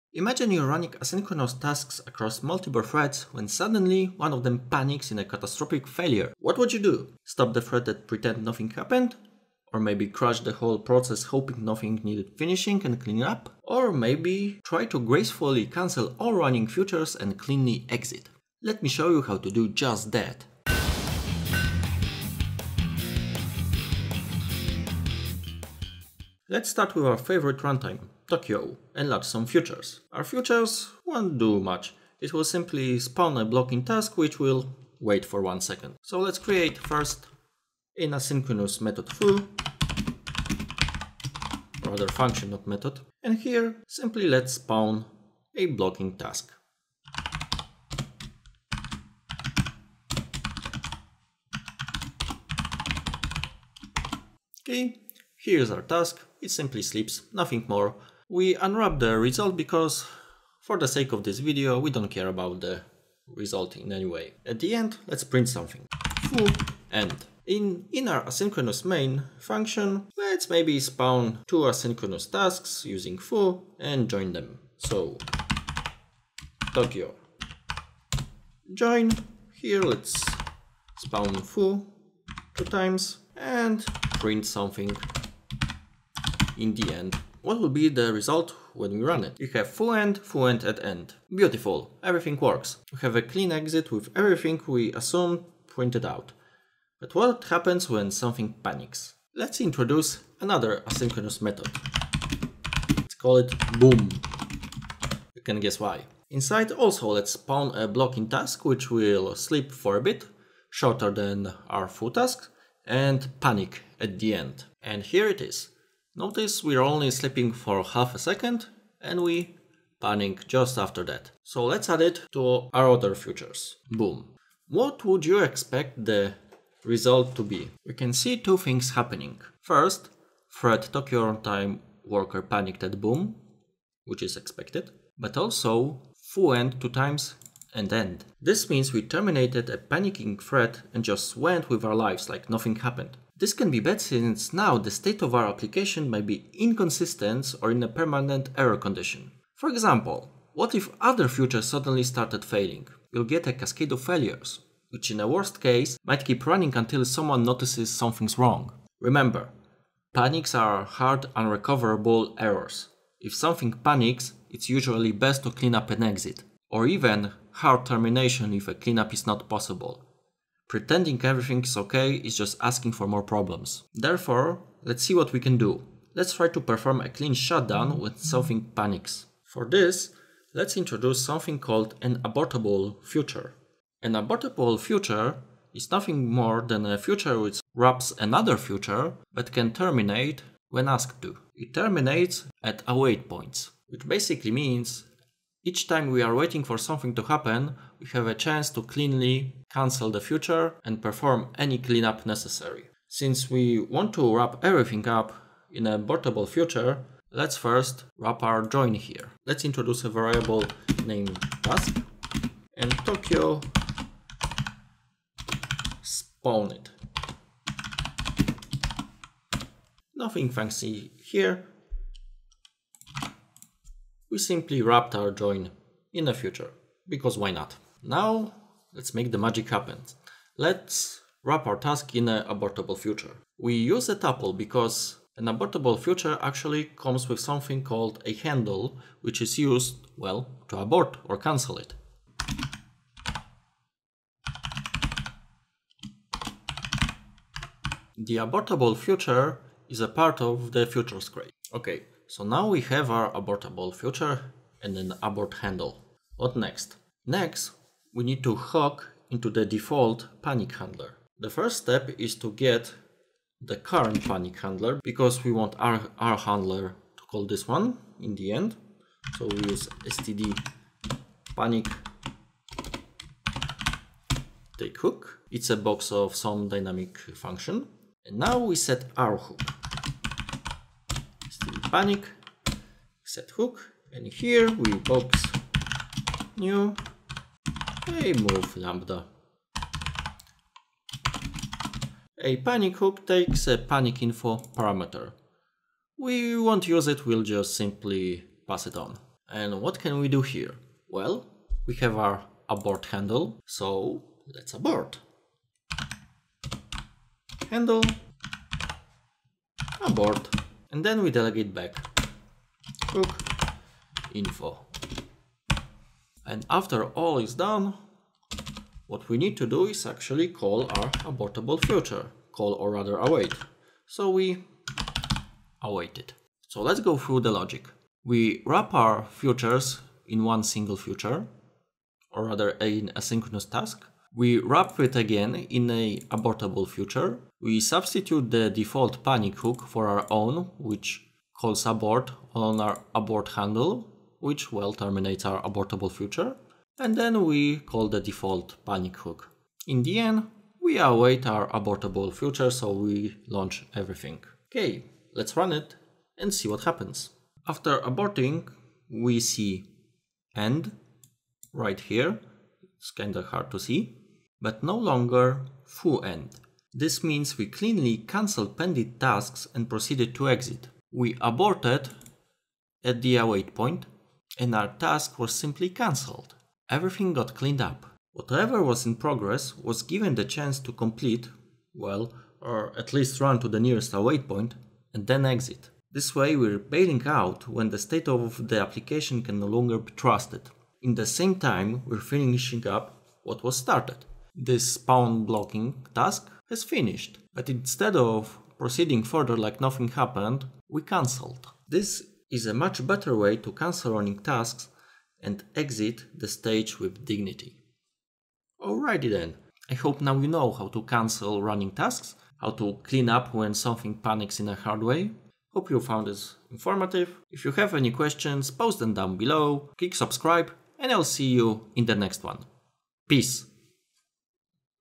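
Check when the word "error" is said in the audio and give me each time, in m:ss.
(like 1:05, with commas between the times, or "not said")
2:28, 2:42.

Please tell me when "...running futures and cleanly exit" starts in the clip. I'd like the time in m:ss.
0:16.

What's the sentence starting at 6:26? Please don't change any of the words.
This way we're bailing out when the state of the application can no longer be trusted.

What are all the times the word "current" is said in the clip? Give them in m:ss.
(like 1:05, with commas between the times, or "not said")
4:23.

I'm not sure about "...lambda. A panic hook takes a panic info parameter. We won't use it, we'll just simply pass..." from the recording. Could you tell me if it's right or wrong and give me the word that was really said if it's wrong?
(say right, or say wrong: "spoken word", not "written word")
right.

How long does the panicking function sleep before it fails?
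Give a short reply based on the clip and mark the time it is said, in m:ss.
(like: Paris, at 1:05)
half a second, at 1:57.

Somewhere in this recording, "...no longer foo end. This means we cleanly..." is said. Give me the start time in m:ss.
6:04.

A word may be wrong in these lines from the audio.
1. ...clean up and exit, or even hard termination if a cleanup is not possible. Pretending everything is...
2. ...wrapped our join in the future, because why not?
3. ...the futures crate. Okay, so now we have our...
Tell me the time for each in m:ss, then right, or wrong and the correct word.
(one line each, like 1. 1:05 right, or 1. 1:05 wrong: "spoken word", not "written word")
1. 2:45 right
2. 3:44 right
3. 4:10 right.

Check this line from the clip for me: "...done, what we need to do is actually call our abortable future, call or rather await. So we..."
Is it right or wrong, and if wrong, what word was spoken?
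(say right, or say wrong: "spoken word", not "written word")
right.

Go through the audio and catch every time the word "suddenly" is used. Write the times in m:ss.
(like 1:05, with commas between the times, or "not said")
0:03, 2:31.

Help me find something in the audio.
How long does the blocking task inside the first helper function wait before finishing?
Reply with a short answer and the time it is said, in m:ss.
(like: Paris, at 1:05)
1 second, at 0:35.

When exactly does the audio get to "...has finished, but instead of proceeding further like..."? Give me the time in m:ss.
6:36.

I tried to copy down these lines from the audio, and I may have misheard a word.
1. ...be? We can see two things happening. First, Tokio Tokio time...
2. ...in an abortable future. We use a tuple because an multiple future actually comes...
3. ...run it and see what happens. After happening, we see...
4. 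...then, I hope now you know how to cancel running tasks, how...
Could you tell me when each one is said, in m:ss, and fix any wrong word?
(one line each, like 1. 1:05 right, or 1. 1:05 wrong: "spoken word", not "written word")
1. 2:07 wrong: "Fred", not "Tokio"
2. 3:52 wrong: "abortable", not "multiple"
3. 5:55 wrong: "aborting", not "happening"
4. 6:49 right.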